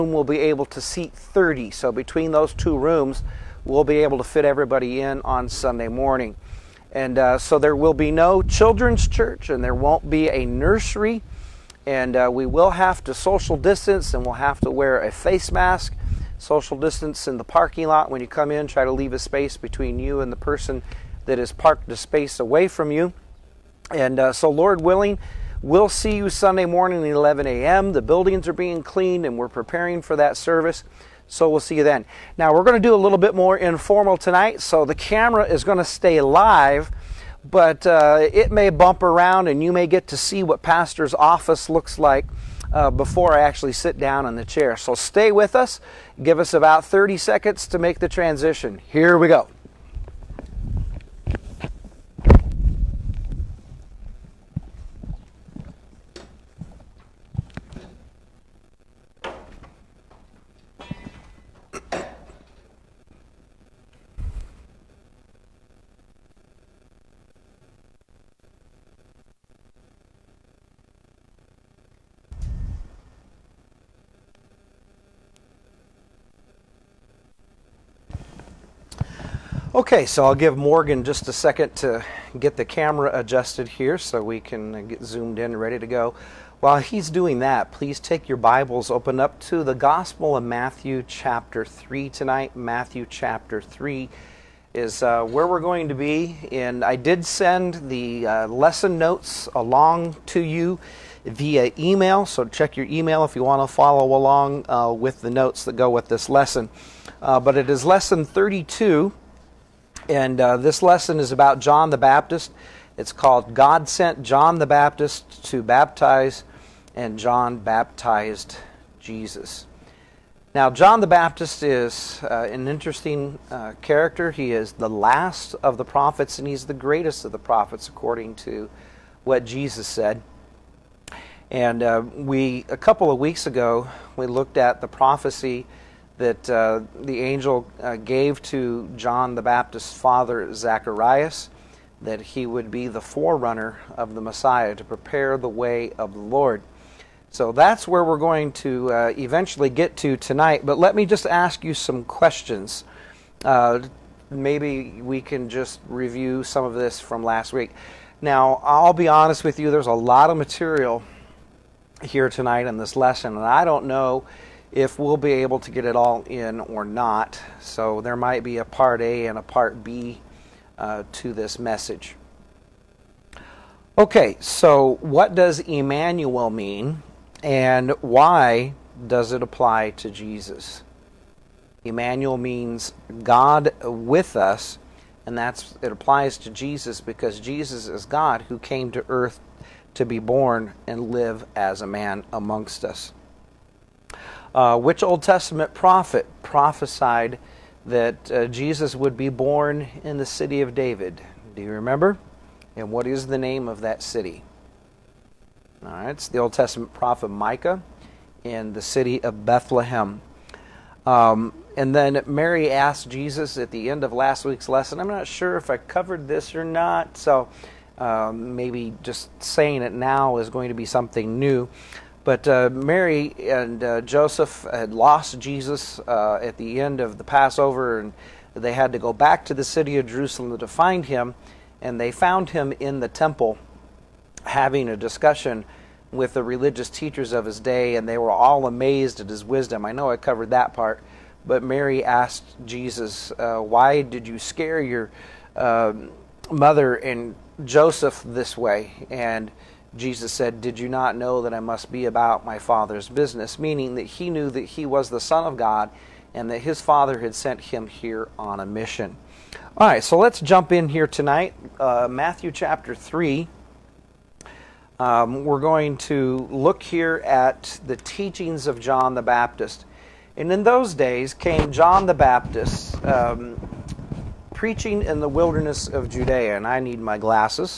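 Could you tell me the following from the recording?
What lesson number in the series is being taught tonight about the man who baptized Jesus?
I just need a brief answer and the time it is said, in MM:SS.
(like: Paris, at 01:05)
32, at 01:47.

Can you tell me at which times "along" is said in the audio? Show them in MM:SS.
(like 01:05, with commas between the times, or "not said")
01:39, 01:44.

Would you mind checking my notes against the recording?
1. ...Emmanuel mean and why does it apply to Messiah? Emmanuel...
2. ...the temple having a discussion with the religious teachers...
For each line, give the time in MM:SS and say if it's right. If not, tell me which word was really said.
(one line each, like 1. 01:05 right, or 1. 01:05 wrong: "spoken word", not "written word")
1. 02:55 wrong: "Jesus", not "Messiah"
2. 03:52 right.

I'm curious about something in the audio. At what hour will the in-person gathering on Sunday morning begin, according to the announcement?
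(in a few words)
11 a.m.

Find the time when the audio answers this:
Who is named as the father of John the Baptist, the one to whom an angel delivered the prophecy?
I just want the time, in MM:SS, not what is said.
02:20.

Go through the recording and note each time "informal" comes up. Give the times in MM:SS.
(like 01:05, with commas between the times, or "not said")
00:33.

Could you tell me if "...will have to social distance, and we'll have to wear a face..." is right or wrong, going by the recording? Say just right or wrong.
right.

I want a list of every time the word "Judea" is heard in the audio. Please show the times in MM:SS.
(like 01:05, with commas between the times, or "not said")
04:36.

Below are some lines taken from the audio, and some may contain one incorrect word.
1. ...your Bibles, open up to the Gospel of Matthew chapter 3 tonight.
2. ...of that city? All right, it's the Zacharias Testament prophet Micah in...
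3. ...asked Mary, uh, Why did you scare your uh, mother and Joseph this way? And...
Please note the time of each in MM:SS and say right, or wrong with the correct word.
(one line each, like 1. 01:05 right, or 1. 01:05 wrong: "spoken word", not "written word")
1. 01:28 right
2. 03:23 wrong: "Old", not "Zacharias"
3. 04:02 wrong: "Jesus", not "Mary".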